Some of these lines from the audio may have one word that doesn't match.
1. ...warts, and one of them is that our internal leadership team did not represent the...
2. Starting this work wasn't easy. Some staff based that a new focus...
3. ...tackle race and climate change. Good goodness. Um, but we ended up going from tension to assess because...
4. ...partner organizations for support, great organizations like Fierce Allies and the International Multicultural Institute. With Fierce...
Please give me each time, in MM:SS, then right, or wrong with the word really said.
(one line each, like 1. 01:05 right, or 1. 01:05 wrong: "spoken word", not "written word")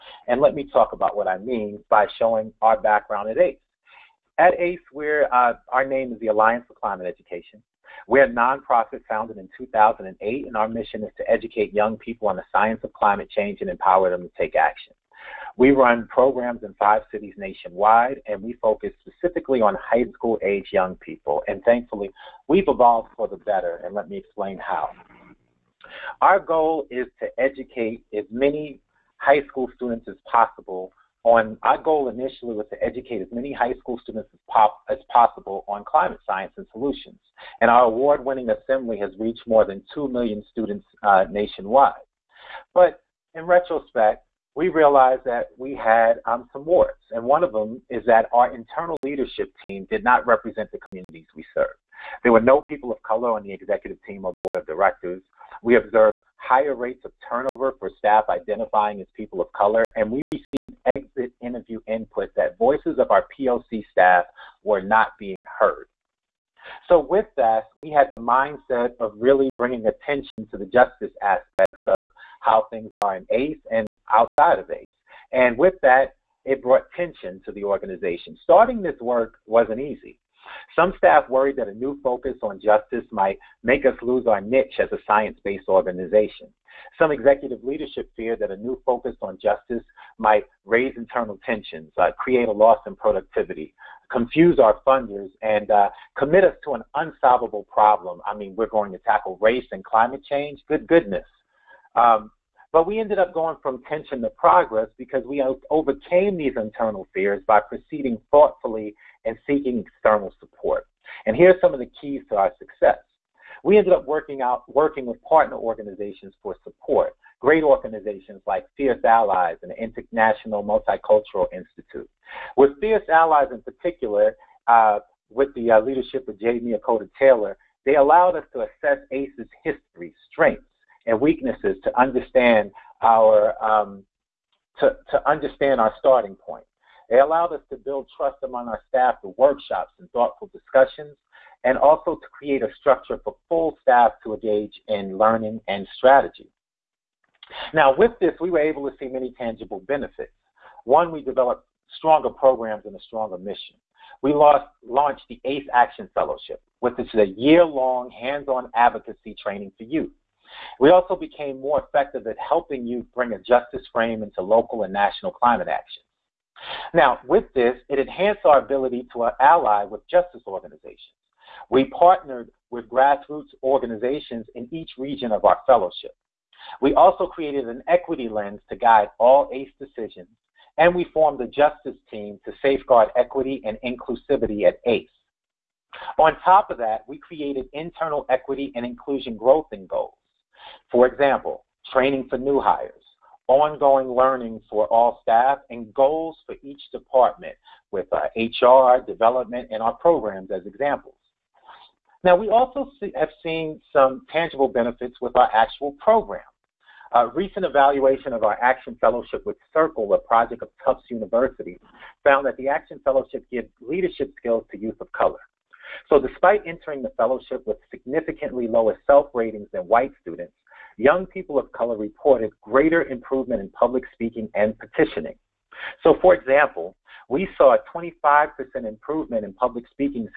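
1. 00:46 right
2. 01:18 wrong: "worried", not "based"
3. 01:38 wrong: "progress", not "assess"
4. 01:55 right.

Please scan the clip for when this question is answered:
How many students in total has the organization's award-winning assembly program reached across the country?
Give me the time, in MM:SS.
00:39.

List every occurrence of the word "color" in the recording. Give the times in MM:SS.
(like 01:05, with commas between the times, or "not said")
00:53, 00:59, 03:35, 03:41.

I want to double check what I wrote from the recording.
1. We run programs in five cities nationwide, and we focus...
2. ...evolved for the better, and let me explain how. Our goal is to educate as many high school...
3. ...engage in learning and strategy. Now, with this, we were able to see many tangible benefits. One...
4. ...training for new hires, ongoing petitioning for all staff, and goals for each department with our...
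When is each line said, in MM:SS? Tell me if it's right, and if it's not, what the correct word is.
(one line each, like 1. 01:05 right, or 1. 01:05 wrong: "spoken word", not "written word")
1. 00:15 right
2. 00:22 right
3. 02:24 right
4. 03:11 wrong: "learning", not "petitioning".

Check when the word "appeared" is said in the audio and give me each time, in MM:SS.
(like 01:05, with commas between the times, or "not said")
not said.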